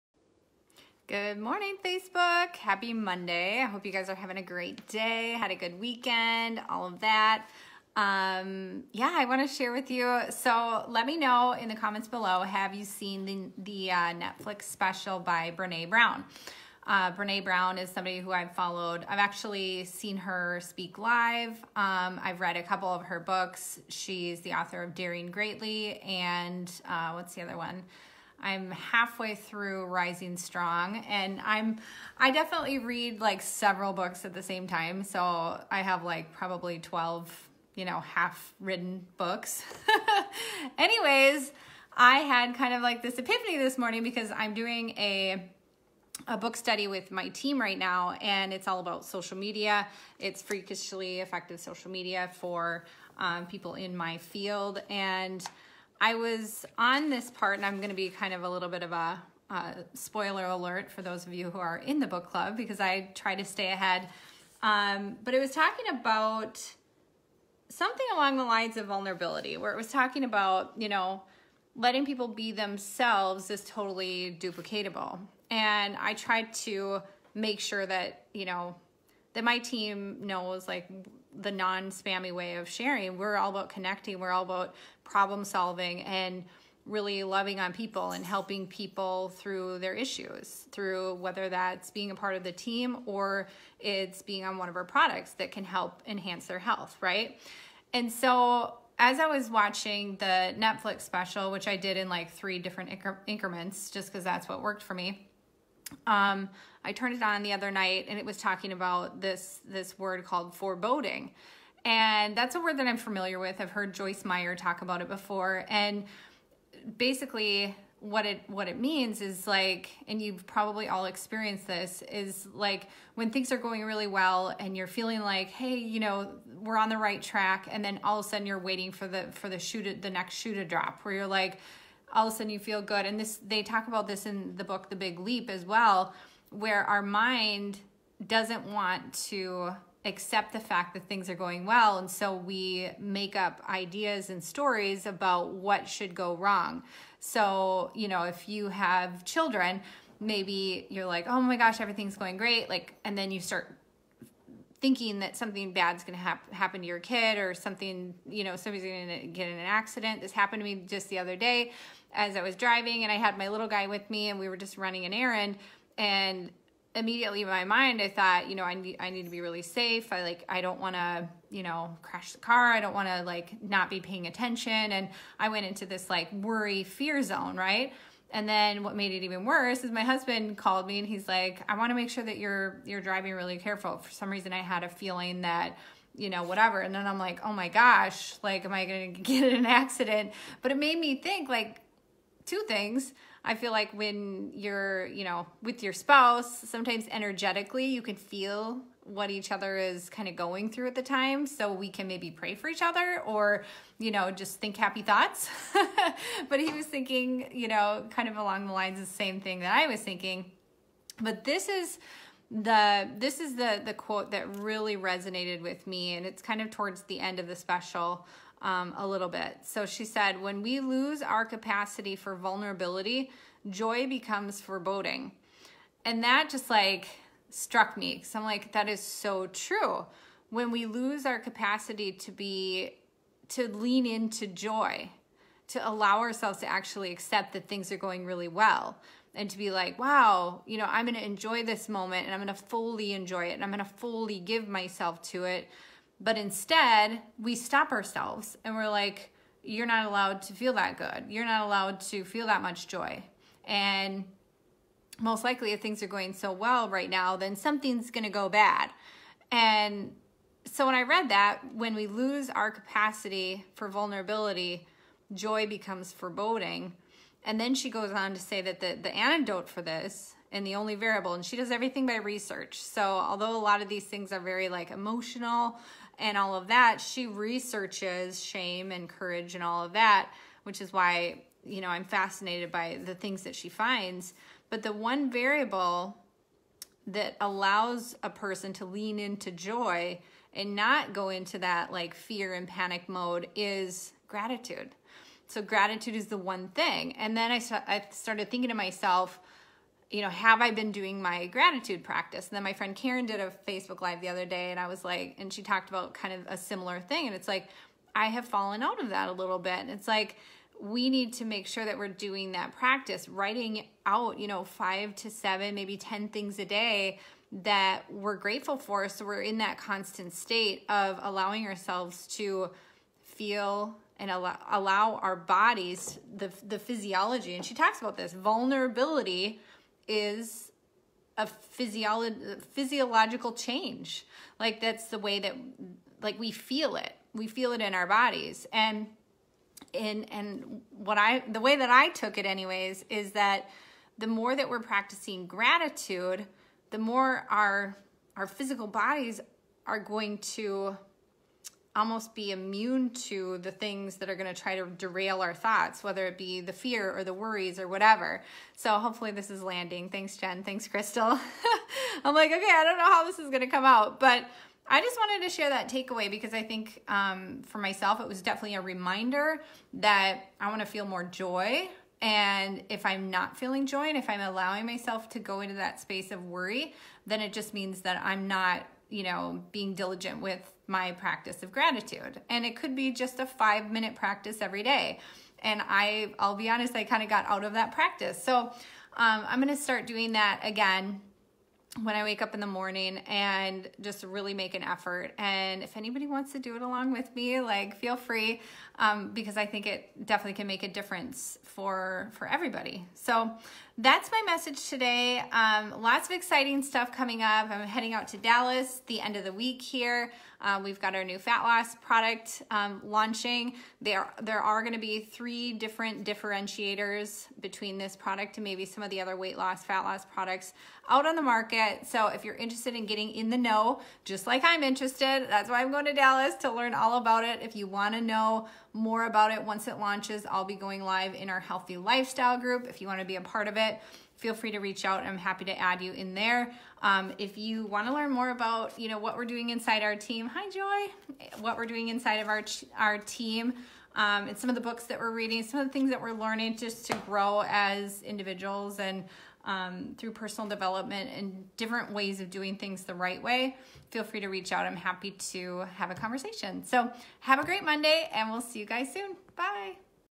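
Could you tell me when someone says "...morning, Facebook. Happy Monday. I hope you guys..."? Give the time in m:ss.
0:01.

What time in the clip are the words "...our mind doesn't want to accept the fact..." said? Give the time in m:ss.
2:16.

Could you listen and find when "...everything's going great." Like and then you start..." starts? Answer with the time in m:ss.
2:31.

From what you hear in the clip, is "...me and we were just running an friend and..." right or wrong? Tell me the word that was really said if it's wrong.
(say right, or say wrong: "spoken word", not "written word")
wrong: "errand", not "friend".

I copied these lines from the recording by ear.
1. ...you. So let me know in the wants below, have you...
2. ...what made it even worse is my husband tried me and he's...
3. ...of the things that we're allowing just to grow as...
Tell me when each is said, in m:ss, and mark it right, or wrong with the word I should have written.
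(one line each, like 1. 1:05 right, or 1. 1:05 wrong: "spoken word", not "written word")
1. 0:09 wrong: "comments", not "wants"
2. 2:58 wrong: "called", not "tried"
3. 7:25 wrong: "learning", not "allowing".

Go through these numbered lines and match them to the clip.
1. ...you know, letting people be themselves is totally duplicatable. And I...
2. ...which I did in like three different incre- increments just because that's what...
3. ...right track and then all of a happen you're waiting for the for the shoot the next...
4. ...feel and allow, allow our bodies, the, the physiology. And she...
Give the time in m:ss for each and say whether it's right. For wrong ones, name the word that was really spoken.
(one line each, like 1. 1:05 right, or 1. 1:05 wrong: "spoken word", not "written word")
1. 1:10 right
2. 1:41 right
3. 2:06 wrong: "sudden", not "happen"
4. 5:23 right.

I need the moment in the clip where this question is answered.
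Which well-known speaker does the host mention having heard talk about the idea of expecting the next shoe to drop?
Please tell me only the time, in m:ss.
1:53.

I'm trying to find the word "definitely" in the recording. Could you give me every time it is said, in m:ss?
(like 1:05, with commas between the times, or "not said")
0:32, 6:08, 6:40.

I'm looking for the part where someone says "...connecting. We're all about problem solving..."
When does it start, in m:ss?
1:23.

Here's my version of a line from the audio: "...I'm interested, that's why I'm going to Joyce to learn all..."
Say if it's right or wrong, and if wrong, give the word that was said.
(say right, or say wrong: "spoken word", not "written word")
wrong: "Dallas", not "Joyce".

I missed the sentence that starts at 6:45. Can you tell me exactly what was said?
Um, lots of exciting stuff coming up.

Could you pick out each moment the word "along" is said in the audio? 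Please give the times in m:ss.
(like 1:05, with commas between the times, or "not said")
1:08, 3:28, 6:36.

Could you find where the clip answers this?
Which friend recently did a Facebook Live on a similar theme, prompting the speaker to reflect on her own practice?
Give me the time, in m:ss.
5:02.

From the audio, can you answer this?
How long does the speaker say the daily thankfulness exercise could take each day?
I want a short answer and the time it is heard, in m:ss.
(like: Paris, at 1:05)
5 minutes, at 6:23.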